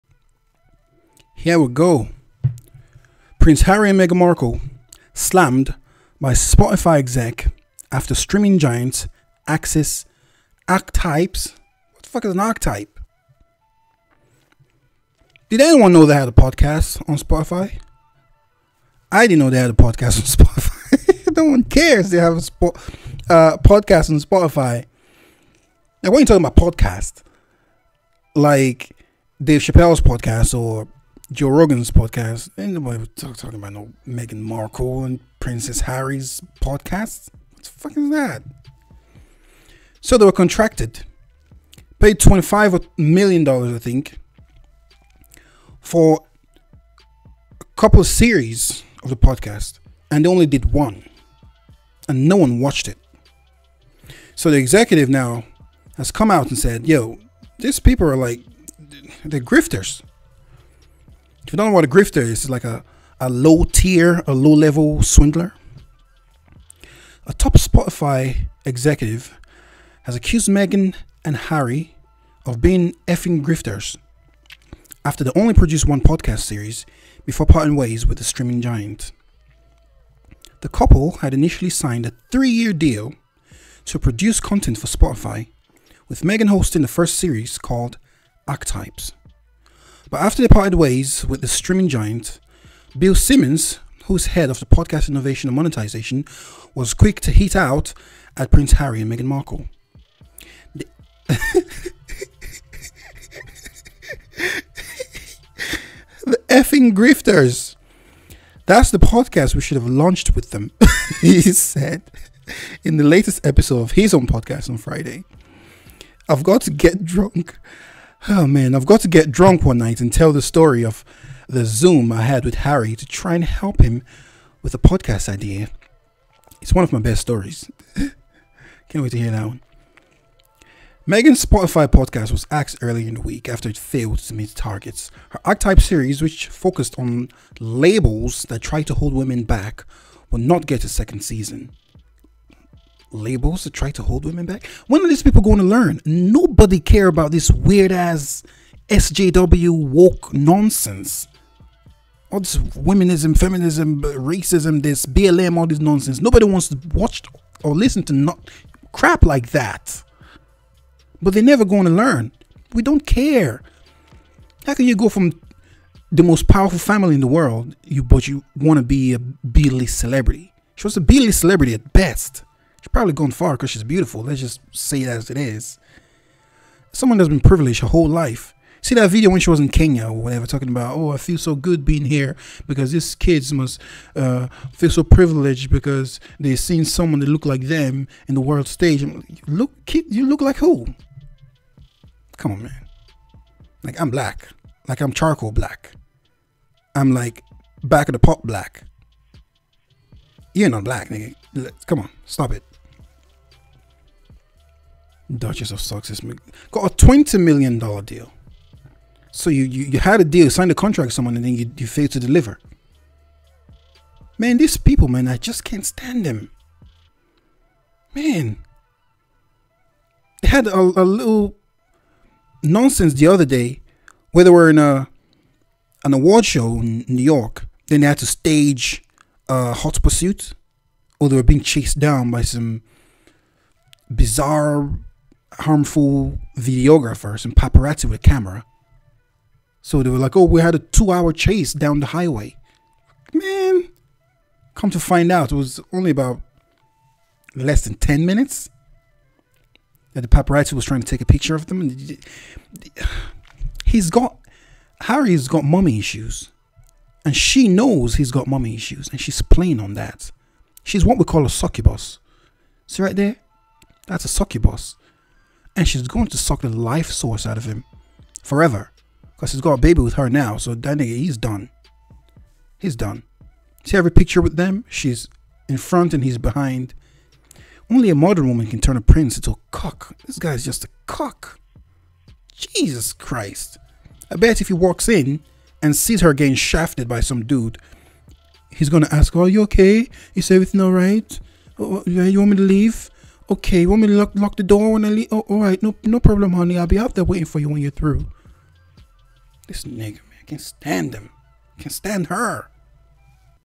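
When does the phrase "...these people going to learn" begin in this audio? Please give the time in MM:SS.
02:25.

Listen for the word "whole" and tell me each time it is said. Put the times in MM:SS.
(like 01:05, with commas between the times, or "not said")
02:57.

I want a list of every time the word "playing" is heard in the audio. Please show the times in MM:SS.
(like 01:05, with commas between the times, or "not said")
04:19.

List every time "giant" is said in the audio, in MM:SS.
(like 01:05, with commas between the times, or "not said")
00:08, 01:18, 01:31.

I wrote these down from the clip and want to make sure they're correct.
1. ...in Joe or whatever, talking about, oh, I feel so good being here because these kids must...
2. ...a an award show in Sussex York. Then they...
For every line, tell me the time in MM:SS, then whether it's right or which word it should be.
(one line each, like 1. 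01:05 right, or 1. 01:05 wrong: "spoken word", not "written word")
1. 02:59 wrong: "Kenya", not "Joe"
2. 03:44 wrong: "New", not "Sussex".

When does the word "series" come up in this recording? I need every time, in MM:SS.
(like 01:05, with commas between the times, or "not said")
00:48, 01:16, 01:27, 02:15.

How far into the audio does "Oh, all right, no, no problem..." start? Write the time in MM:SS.
04:55.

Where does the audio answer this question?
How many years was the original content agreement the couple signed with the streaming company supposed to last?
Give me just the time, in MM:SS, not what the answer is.
01:22.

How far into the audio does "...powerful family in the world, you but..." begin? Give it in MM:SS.
02:46.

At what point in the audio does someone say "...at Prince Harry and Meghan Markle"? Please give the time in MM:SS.
01:38.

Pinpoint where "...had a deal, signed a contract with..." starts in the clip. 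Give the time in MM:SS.
03:29.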